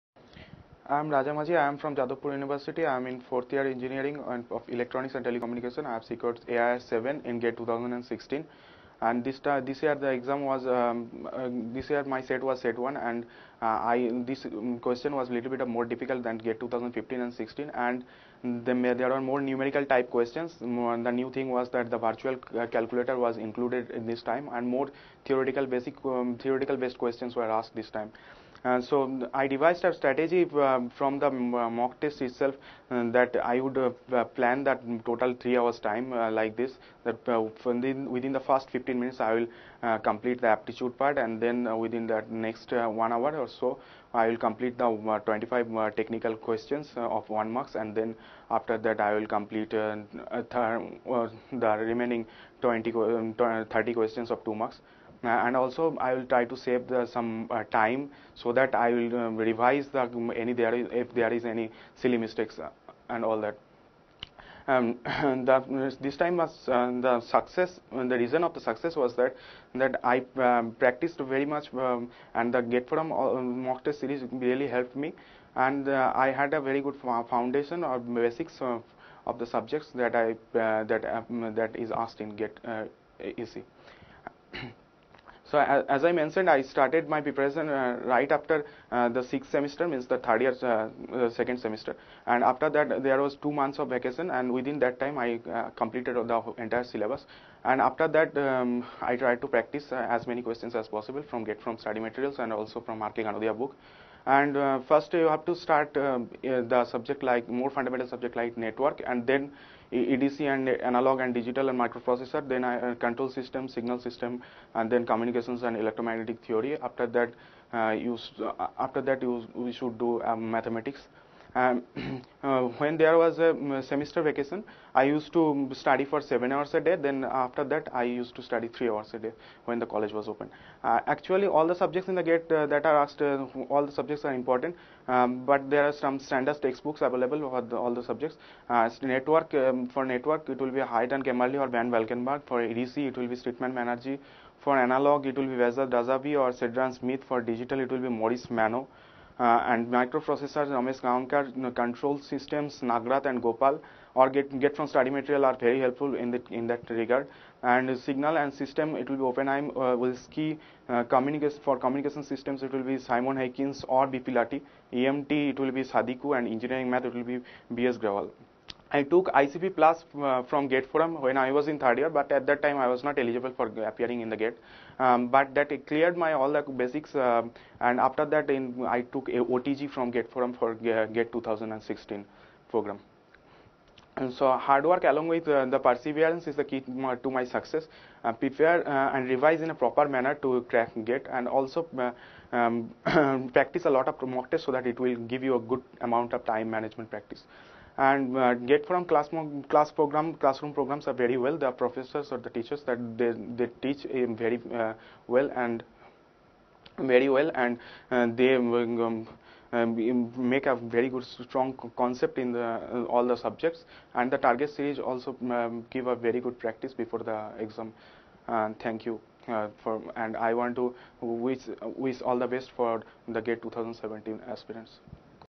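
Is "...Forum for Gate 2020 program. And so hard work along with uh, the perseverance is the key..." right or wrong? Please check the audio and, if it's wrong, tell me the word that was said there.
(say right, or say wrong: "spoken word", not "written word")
wrong: "2016", not "2020".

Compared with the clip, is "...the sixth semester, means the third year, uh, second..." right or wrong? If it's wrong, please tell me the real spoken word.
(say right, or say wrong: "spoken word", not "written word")
right.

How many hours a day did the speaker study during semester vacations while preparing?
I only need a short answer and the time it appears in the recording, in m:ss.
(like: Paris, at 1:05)
7 hours, at 2:06.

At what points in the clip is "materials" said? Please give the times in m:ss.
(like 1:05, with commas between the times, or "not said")
1:41, 2:35.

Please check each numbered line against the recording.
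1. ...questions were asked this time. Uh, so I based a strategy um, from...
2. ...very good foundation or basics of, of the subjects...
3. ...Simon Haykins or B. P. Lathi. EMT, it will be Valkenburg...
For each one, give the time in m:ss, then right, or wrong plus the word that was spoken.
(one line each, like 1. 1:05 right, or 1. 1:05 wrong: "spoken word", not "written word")
1. 0:26 wrong: "devised", not "based"
2. 1:16 right
3. 2:42 wrong: "Sadiku", not "Valkenburg".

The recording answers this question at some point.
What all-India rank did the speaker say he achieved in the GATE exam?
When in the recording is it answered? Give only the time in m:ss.
0:06.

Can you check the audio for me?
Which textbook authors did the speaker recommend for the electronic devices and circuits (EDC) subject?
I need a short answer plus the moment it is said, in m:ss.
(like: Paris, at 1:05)
Streetman Banerjee, at 2:23.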